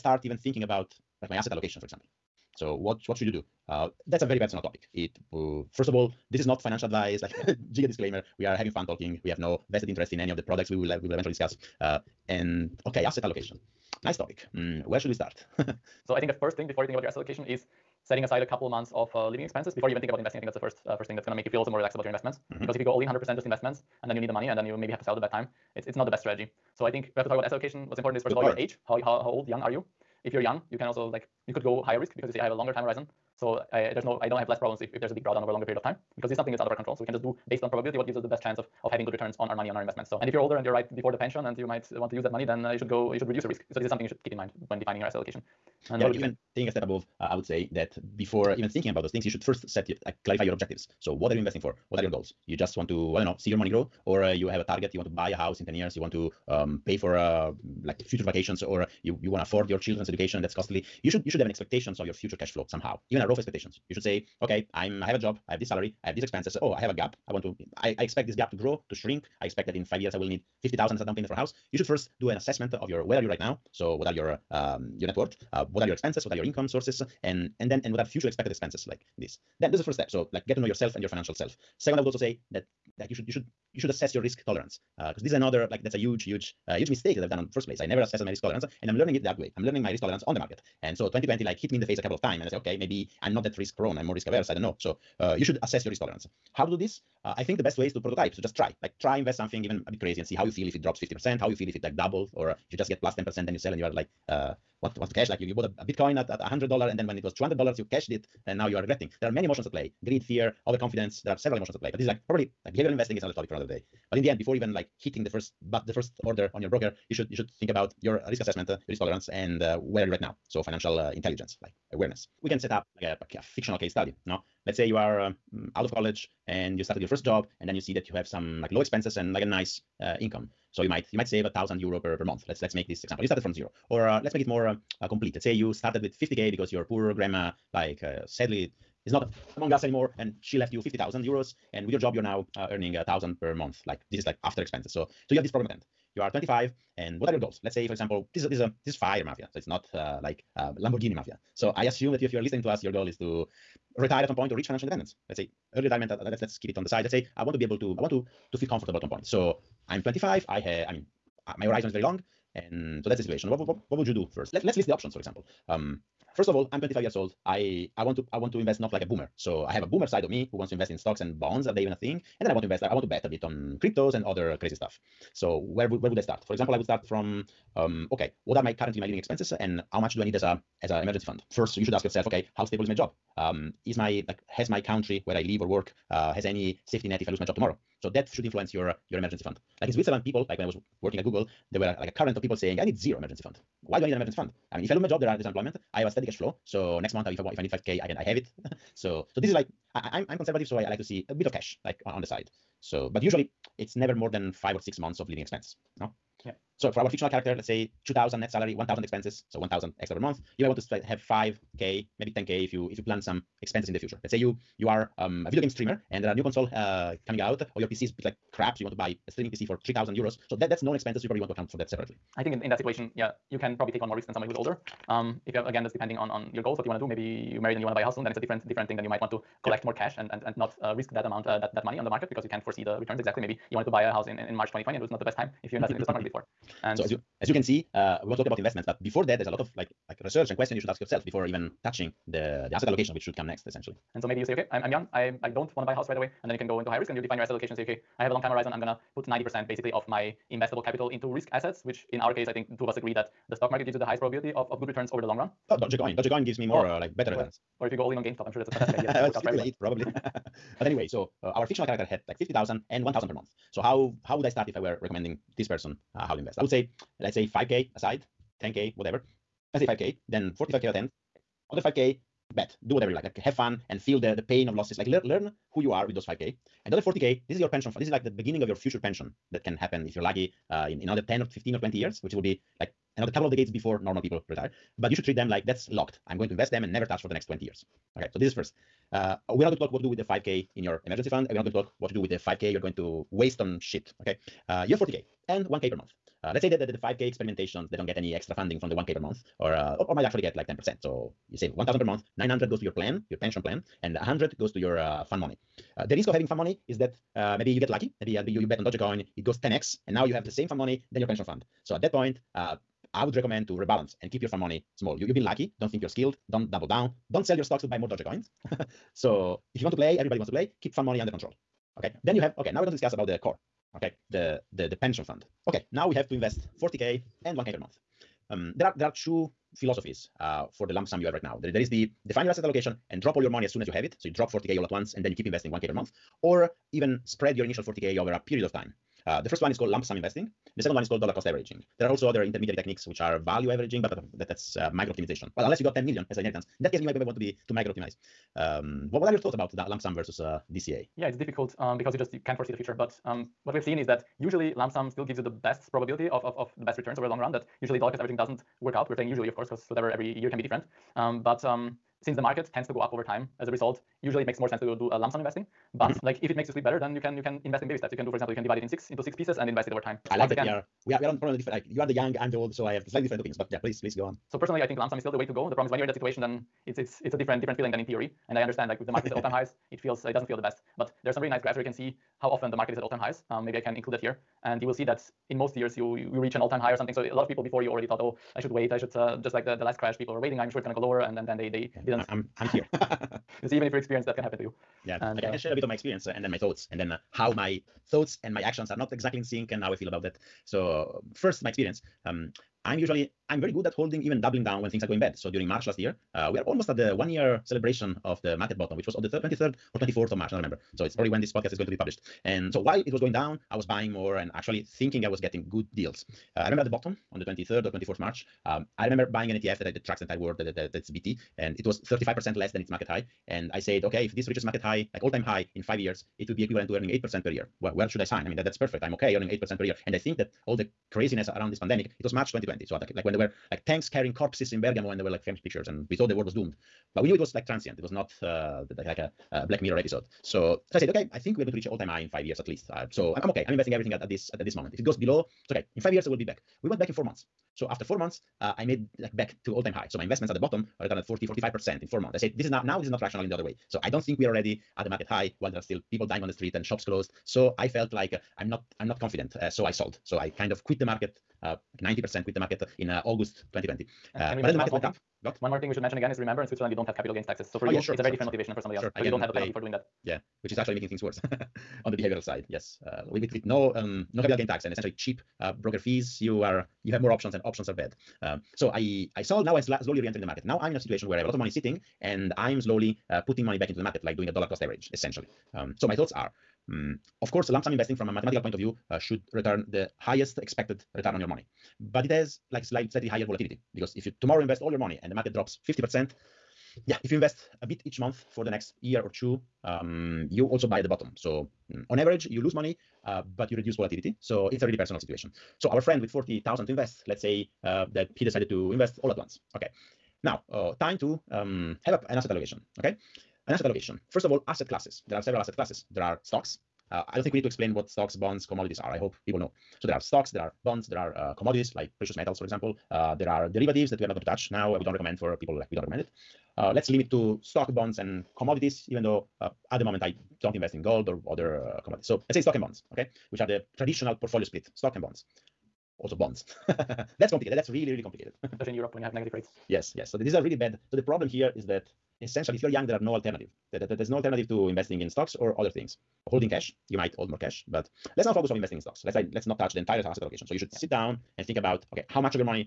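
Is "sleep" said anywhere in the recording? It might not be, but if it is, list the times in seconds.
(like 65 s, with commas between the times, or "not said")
366 s.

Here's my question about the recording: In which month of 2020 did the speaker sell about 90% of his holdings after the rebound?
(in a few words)
August.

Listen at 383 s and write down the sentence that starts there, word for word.
Um, maybe I can include that here.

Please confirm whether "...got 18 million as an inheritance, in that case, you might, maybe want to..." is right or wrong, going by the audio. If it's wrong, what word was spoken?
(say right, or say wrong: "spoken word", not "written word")
wrong: "10", not "18".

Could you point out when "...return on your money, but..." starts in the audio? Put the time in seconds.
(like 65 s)
491 s.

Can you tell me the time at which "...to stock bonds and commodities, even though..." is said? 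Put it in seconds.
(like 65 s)
527 s.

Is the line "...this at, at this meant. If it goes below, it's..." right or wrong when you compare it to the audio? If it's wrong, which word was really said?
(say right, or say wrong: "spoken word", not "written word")
wrong: "moment", not "meant".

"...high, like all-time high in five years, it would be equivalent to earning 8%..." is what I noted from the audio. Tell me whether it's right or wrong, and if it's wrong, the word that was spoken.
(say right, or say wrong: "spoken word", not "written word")
right.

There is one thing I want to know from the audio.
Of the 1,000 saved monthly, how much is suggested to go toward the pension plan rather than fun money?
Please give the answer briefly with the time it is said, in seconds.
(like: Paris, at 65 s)
900, at 302 s.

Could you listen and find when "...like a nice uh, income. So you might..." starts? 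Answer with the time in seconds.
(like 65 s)
129 s.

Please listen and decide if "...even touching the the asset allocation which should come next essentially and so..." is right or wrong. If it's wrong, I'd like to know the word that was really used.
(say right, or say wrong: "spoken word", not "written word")
right.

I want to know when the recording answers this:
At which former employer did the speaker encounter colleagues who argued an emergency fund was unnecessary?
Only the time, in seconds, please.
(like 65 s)
191 s.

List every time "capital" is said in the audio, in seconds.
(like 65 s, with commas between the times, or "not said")
250 s, 467 s, 474 s.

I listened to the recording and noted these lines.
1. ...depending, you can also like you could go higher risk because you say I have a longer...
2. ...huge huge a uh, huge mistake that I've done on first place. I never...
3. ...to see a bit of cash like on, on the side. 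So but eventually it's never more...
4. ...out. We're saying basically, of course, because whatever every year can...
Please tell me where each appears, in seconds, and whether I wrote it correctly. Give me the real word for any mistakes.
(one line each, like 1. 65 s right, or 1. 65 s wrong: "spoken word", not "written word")
1. 30 s wrong: "young", not "depending"
2. 85 s right
3. 200 s wrong: "usually", not "eventually"
4. 358 s wrong: "usually", not "basically".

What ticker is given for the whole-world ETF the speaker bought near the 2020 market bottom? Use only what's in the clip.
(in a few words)
VT.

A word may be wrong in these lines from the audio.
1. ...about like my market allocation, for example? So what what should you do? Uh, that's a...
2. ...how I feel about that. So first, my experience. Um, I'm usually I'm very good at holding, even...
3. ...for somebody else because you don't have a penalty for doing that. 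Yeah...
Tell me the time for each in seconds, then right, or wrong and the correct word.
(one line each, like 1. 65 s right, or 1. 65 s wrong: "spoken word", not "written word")
1. 0 s wrong: "asset", not "market"
2. 399 s right
3. 468 s right.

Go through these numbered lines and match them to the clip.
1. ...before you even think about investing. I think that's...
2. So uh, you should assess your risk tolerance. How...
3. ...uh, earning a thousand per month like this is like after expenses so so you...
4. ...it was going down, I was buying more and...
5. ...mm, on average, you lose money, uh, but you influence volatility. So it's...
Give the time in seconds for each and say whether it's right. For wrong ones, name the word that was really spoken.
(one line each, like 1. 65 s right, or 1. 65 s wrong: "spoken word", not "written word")
1. 19 s right
2. 94 s right
3. 142 s right
4. 413 s right
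5. 501 s wrong: "reduce", not "influence".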